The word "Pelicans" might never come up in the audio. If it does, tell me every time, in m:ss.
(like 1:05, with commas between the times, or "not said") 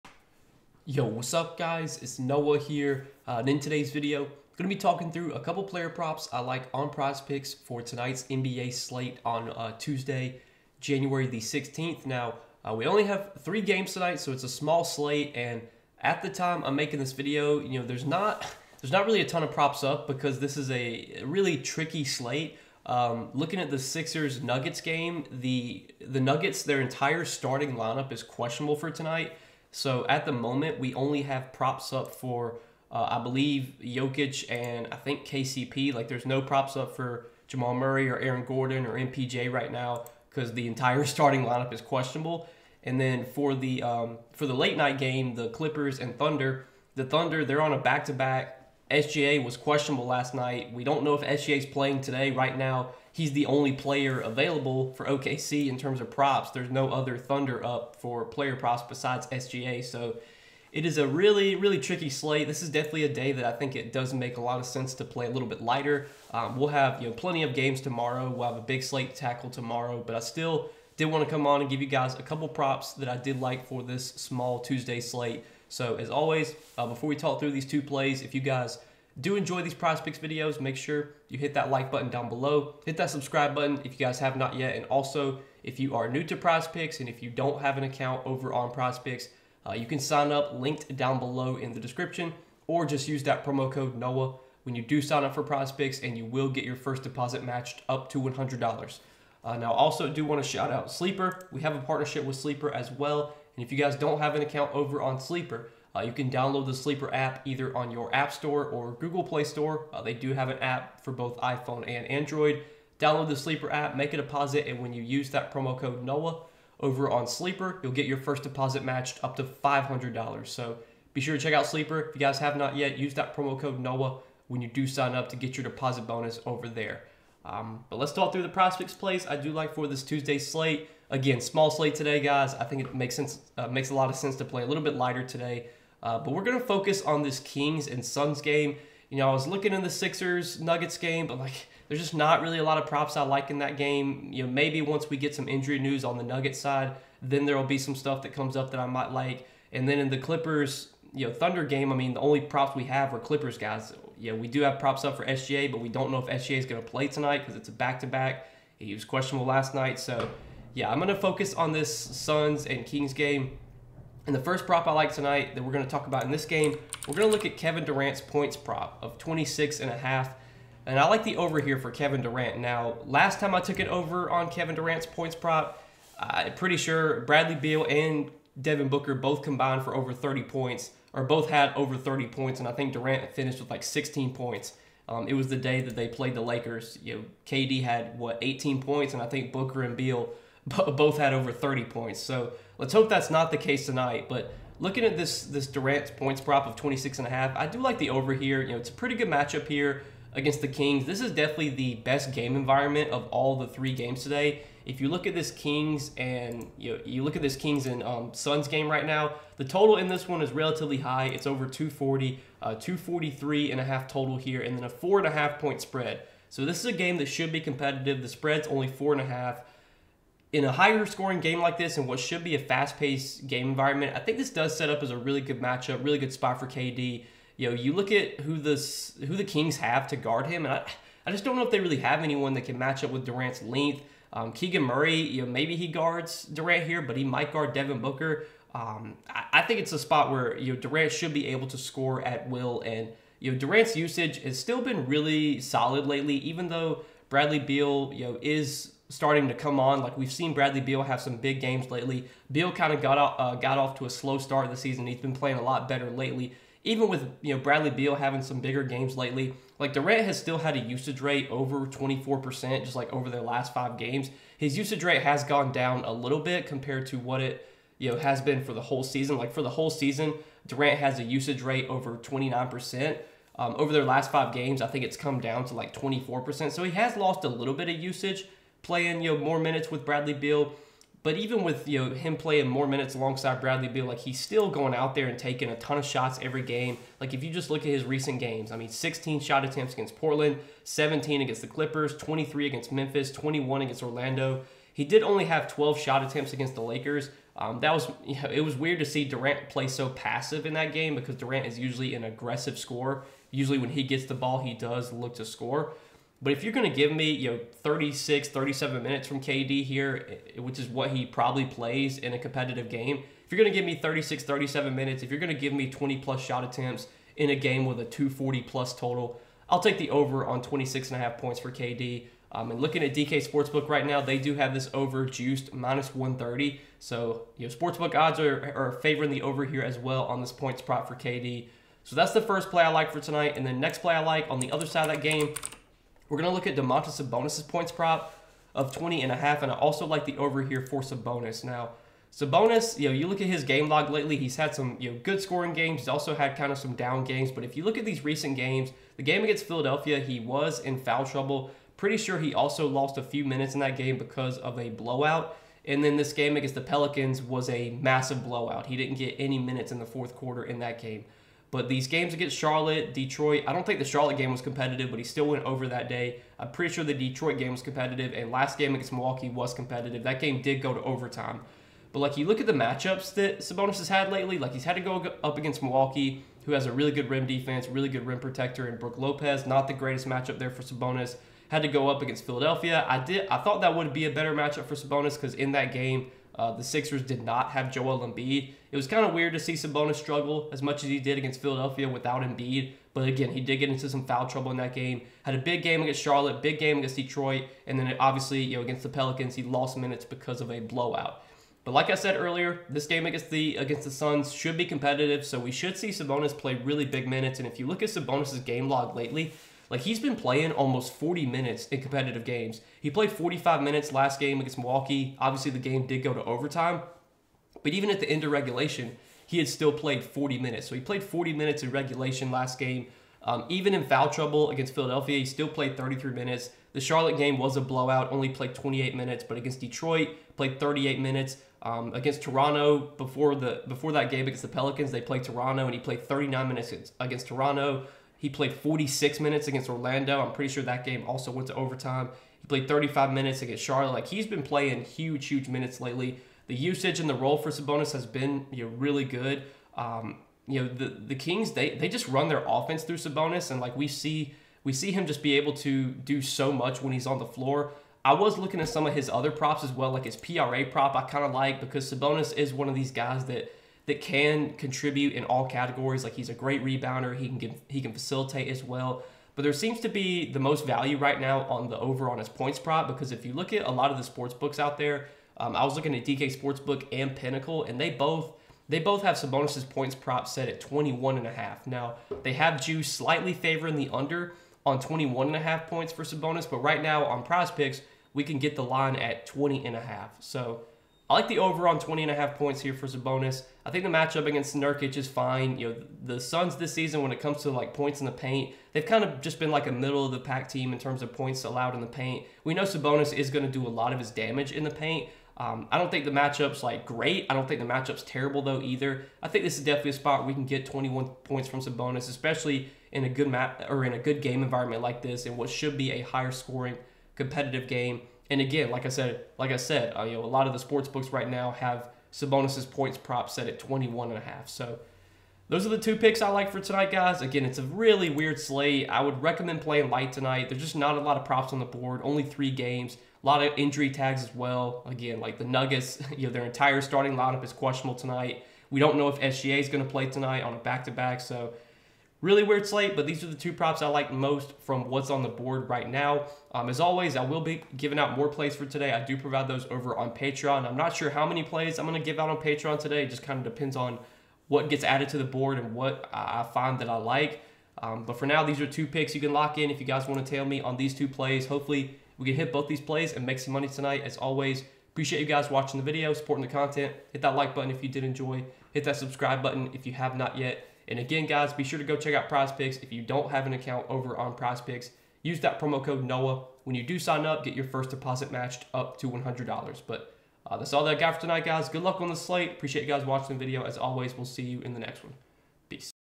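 5:56, 6:39, 7:14.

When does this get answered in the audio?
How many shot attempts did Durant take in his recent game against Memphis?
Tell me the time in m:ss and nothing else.
4:52.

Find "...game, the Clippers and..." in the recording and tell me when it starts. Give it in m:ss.
0:44.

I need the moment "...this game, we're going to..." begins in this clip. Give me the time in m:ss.
2:46.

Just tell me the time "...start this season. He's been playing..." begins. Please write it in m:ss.
4:14.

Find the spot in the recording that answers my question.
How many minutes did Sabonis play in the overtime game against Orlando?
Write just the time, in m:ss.
7:18.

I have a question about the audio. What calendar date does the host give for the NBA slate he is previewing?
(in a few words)
January 16th.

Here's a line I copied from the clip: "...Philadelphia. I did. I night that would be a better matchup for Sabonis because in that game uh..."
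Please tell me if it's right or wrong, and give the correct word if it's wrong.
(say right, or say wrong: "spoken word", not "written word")
wrong: "thought", not "night".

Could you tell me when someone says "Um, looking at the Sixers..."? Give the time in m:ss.
0:22.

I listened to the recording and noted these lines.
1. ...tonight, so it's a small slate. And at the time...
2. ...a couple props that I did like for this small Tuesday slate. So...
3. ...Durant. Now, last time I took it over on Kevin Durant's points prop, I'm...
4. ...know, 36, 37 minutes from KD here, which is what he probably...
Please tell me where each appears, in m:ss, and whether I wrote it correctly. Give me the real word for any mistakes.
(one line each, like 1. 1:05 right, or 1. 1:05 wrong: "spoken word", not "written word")
1. 0:13 right
2. 1:12 right
3. 2:52 right
4. 5:07 right.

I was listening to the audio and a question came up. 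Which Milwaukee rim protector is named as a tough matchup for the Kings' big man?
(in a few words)
Brooke Lopez.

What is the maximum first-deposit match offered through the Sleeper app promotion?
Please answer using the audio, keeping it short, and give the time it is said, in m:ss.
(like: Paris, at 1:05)
$500, at 1:59.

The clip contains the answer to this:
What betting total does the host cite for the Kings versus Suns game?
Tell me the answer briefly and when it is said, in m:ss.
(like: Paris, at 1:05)
243.5, at 3:32.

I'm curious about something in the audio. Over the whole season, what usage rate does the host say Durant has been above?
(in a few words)
29%.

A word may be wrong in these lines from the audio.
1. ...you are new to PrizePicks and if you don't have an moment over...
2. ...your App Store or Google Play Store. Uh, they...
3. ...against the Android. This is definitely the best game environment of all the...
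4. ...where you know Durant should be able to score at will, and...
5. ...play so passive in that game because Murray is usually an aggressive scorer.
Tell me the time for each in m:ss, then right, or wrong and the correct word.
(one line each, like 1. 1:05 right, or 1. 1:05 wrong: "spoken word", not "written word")
1. 1:25 wrong: "account", not "moment"
2. 1:47 right
3. 3:20 wrong: "Kings", not "Android"
4. 4:00 right
5. 4:59 wrong: "Durant", not "Murray".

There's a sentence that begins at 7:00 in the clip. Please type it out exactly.
So he played 40 minutes in regulation last game.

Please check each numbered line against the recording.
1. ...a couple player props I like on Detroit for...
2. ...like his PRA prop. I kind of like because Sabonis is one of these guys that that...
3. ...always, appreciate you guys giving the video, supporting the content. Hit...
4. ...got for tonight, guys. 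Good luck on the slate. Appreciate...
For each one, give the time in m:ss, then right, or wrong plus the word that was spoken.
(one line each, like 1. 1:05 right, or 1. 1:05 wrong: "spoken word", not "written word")
1. 0:05 wrong: "PrizePicks", not "Detroit"
2. 7:40 right
3. 9:24 wrong: "watching", not "giving"
4. 9:41 right.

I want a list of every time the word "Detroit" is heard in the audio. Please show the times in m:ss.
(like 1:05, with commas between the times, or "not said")
6:03, 6:07, 6:37, 7:09.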